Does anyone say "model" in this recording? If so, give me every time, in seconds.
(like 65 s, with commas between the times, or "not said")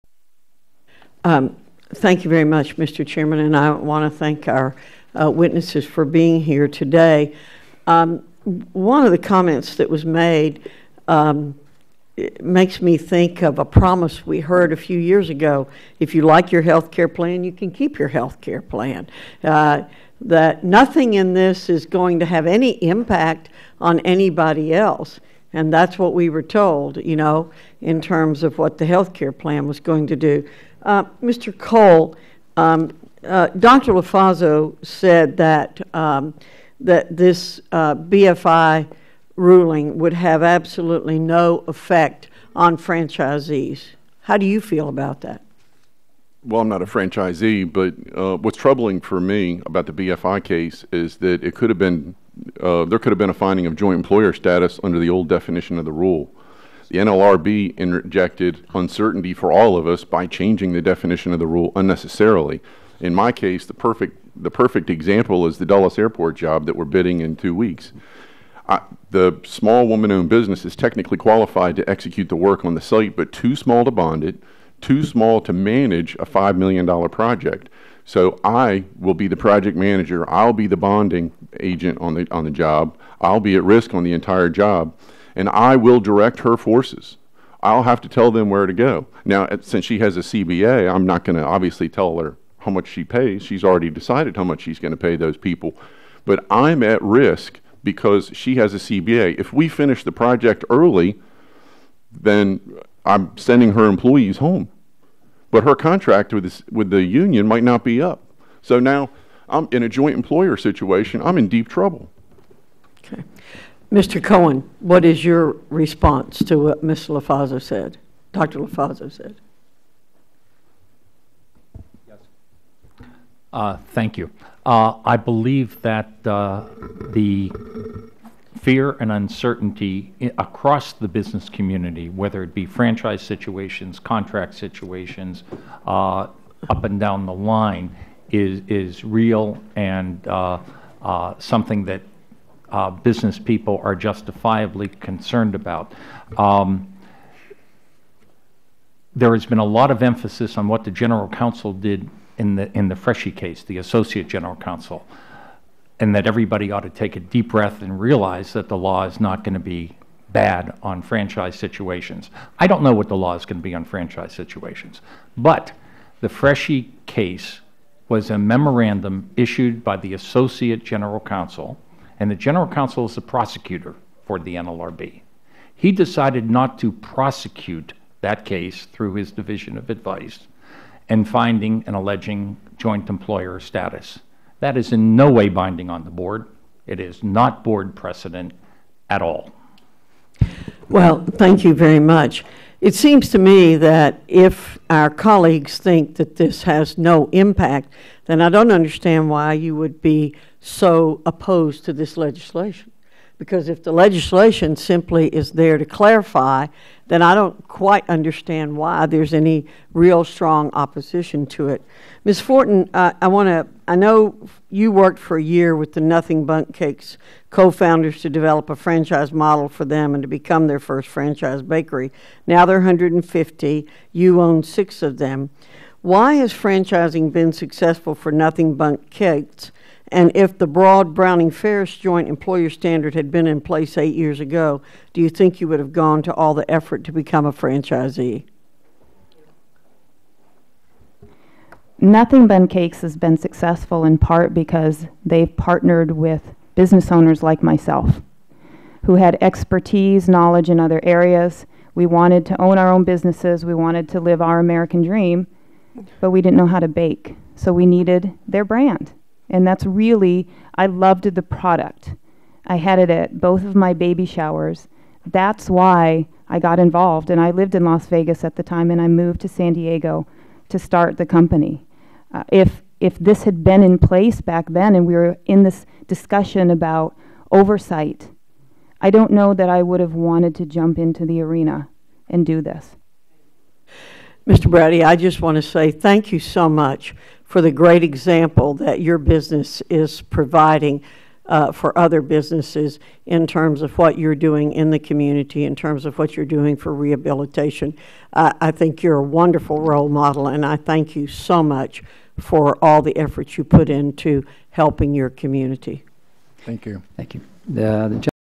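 219 s, 300 s.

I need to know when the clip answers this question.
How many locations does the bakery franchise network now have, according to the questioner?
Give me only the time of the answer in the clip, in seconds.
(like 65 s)
222 s.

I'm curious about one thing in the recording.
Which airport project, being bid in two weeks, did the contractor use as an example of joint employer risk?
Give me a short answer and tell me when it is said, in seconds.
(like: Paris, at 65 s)
Dulles Airport, at 65 s.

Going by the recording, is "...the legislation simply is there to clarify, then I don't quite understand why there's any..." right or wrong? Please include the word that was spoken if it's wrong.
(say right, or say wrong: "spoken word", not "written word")
right.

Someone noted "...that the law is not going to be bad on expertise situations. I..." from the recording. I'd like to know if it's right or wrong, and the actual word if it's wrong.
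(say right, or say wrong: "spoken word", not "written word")
wrong: "franchise", not "expertise".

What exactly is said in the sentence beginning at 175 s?
He decided not to prosecute that case through his division of advice and finding and alleging joint employer status.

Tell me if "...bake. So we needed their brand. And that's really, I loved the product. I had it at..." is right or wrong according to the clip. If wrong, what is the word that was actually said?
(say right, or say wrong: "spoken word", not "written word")
right.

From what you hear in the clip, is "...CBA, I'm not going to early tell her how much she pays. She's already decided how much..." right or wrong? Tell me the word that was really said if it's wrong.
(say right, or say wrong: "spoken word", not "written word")
wrong: "obviously", not "early".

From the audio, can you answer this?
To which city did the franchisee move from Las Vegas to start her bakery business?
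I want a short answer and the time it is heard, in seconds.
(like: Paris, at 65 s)
San Diego, at 269 s.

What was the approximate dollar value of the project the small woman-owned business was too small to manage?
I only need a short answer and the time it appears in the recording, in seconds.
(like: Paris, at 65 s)
$5 million, at 76 s.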